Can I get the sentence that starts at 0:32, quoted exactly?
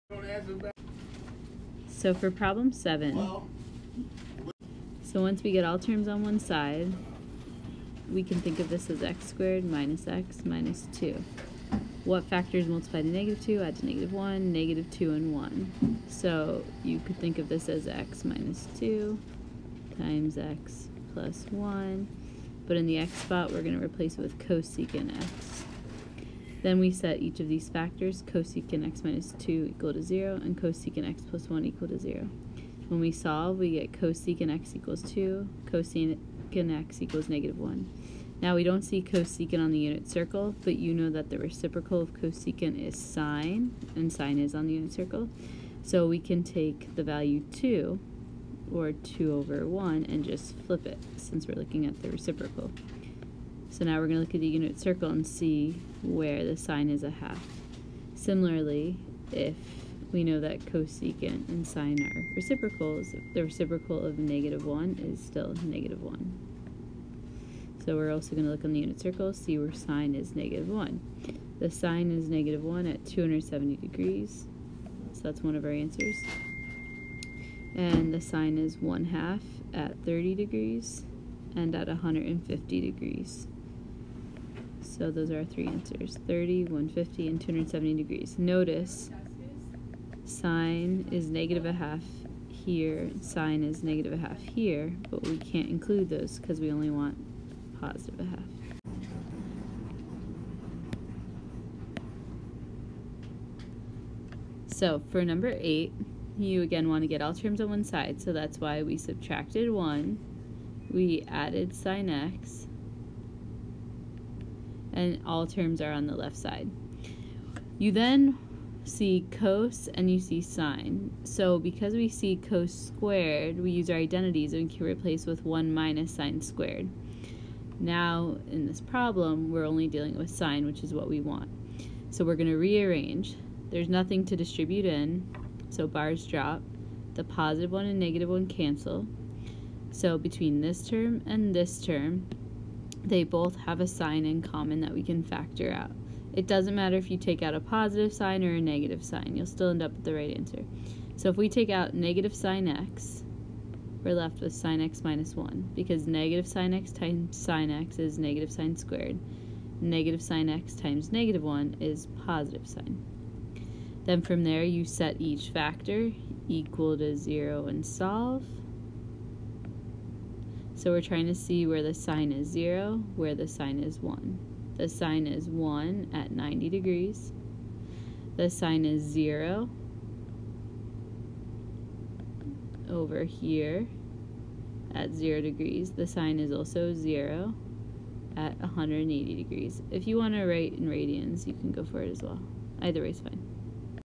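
When we solve, we get cosecant x equals 2, cosecant x equals negative 1.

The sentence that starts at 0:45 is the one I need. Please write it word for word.
So we can take the value 2, or 2 over 1, and just flip it, since we're looking at the reciprocal.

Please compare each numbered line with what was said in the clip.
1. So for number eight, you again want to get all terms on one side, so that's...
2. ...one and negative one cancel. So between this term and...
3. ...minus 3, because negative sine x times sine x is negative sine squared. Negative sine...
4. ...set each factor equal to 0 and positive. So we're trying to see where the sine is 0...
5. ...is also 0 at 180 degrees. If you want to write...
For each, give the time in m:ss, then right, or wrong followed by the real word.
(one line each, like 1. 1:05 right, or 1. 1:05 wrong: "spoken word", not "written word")
1. 1:44 right
2. 2:17 right
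3. 2:35 wrong: "1", not "3"
4. 2:44 wrong: "solve", not "positive"
5. 3:06 right.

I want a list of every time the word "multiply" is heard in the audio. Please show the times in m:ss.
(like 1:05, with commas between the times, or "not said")
0:12.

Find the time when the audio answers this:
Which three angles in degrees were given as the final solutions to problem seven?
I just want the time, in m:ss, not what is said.
1:26.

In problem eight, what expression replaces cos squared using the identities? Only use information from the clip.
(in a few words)
1 minus sine squared.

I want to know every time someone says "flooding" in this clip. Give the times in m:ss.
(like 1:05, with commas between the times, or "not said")
not said.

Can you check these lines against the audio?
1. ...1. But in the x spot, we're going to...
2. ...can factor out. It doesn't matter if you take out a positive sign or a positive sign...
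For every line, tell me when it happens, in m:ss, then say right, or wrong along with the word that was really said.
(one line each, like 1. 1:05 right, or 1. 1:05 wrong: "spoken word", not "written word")
1. 0:21 right
2. 2:25 wrong: "negative", not "positive".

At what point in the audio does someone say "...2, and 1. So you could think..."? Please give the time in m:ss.
0:14.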